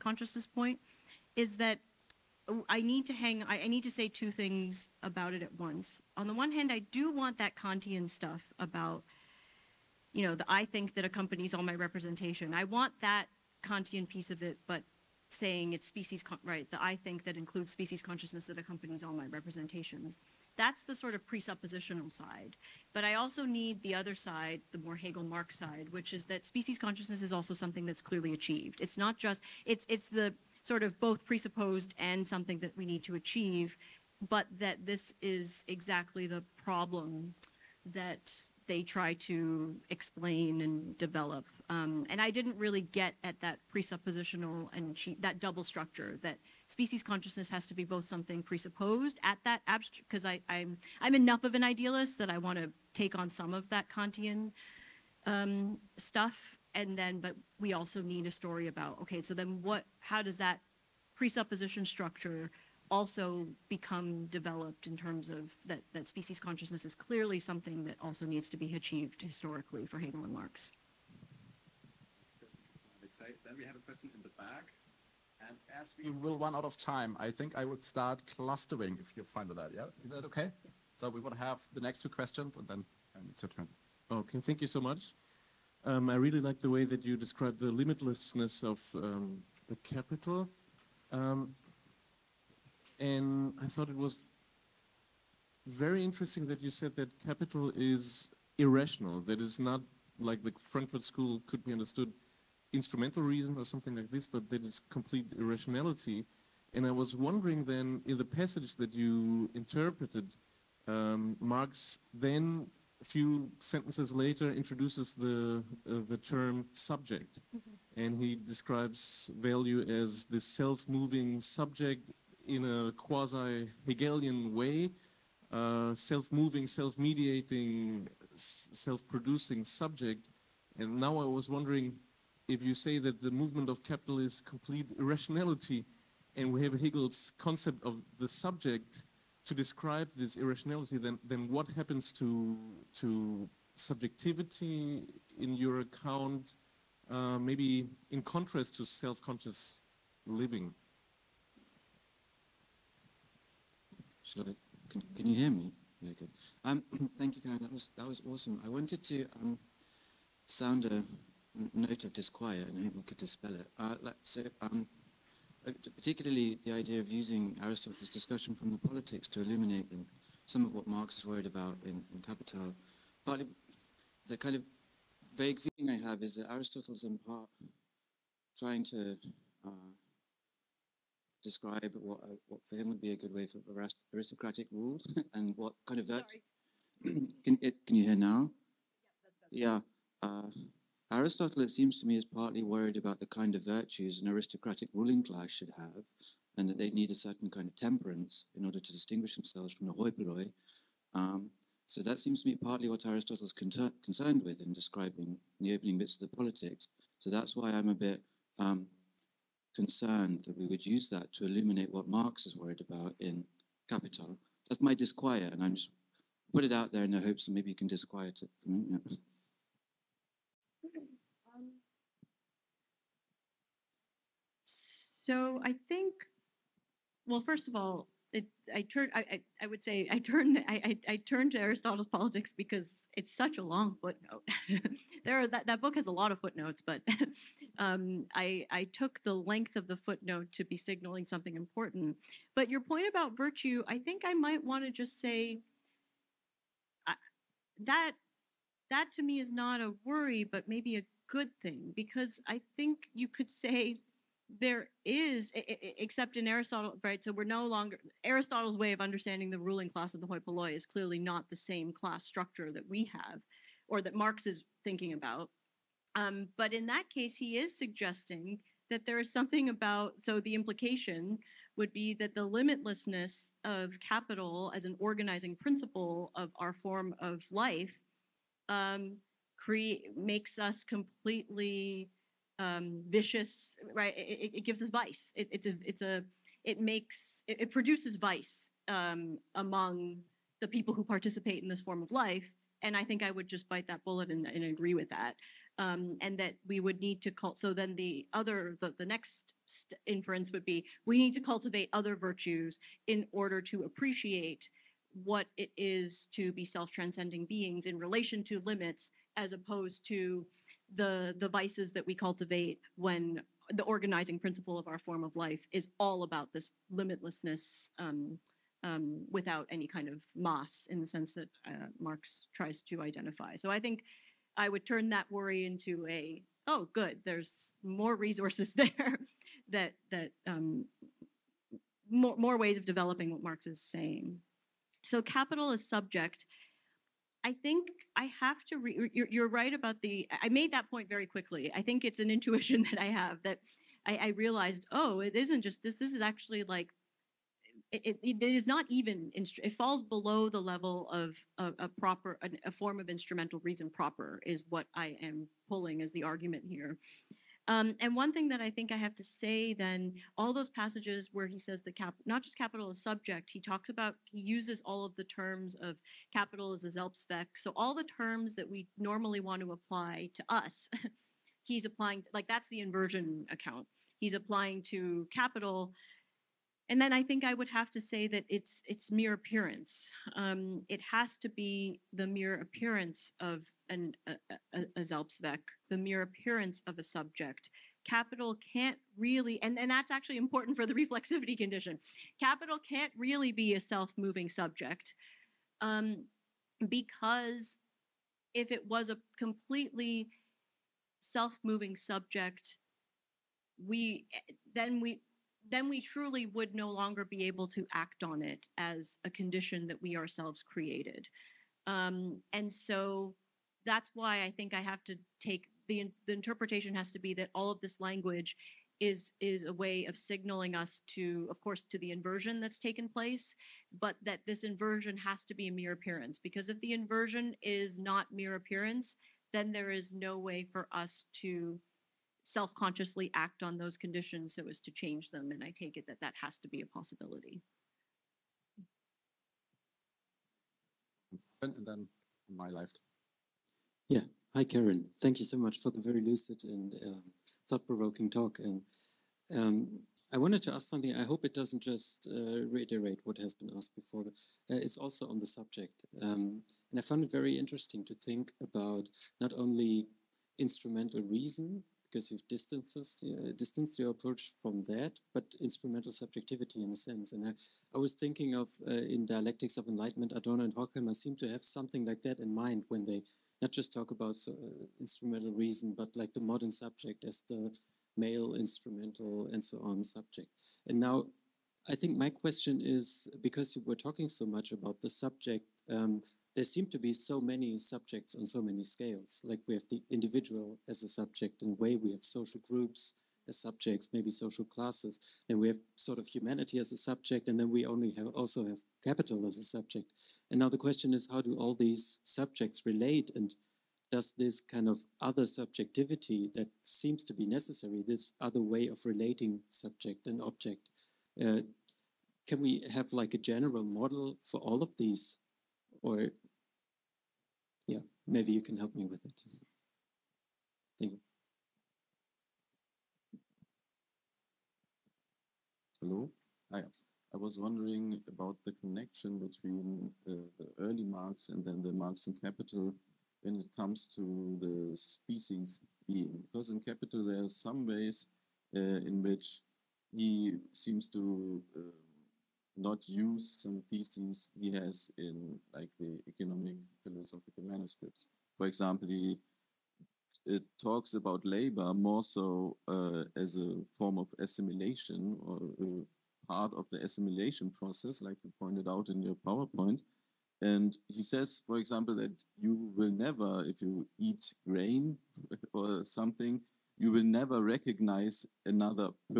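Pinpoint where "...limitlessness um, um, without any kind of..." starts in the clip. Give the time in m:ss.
5:16.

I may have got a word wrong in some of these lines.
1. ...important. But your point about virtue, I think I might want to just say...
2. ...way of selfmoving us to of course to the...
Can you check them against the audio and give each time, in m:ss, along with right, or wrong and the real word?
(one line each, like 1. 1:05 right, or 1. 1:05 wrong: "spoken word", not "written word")
1. 4:01 right
2. 6:59 wrong: "signaling", not "selfmoving".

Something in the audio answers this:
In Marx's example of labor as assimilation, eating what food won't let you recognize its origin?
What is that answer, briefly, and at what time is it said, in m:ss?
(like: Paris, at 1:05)
grain, at 9:24.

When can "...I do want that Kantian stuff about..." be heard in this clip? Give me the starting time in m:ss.
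0:06.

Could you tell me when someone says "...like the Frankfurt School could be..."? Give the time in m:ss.
1:40.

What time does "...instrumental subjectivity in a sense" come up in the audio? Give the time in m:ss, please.
7:45.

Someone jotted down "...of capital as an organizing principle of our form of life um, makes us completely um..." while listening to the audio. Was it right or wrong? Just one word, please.
right.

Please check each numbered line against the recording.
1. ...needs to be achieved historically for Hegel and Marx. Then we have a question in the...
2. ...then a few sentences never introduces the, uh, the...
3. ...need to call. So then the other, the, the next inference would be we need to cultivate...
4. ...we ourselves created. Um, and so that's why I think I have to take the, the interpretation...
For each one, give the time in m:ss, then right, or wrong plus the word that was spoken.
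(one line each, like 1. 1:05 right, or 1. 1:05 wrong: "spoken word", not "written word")
1. 1:08 right
2. 1:52 wrong: "later", not "never"
3. 4:57 right
4. 6:50 right.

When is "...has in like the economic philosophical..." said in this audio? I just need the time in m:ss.
9:04.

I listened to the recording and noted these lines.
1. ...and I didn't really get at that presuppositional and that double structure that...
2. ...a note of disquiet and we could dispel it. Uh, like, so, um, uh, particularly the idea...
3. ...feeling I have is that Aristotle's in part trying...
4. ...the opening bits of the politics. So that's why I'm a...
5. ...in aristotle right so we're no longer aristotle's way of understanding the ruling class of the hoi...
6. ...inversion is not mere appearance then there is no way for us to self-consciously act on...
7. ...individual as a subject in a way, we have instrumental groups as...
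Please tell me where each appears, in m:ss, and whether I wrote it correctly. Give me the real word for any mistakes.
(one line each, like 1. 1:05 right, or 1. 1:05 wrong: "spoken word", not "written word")
1. 0:42 right
2. 2:40 right
3. 2:55 right
4. 3:25 right
5. 4:16 right
6. 7:06 right
7. 8:10 wrong: "social", not "instrumental".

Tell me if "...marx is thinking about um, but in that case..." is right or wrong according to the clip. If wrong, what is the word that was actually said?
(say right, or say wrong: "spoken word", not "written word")
right.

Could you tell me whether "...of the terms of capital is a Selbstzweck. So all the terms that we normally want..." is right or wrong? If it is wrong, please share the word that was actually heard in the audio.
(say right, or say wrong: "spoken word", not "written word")
right.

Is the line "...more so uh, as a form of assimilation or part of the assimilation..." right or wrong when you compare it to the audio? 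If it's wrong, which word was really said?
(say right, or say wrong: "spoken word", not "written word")
right.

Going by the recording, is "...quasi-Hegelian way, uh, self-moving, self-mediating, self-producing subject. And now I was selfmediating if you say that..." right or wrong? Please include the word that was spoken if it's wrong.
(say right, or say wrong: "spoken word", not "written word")
wrong: "wondering", not "selfmediating".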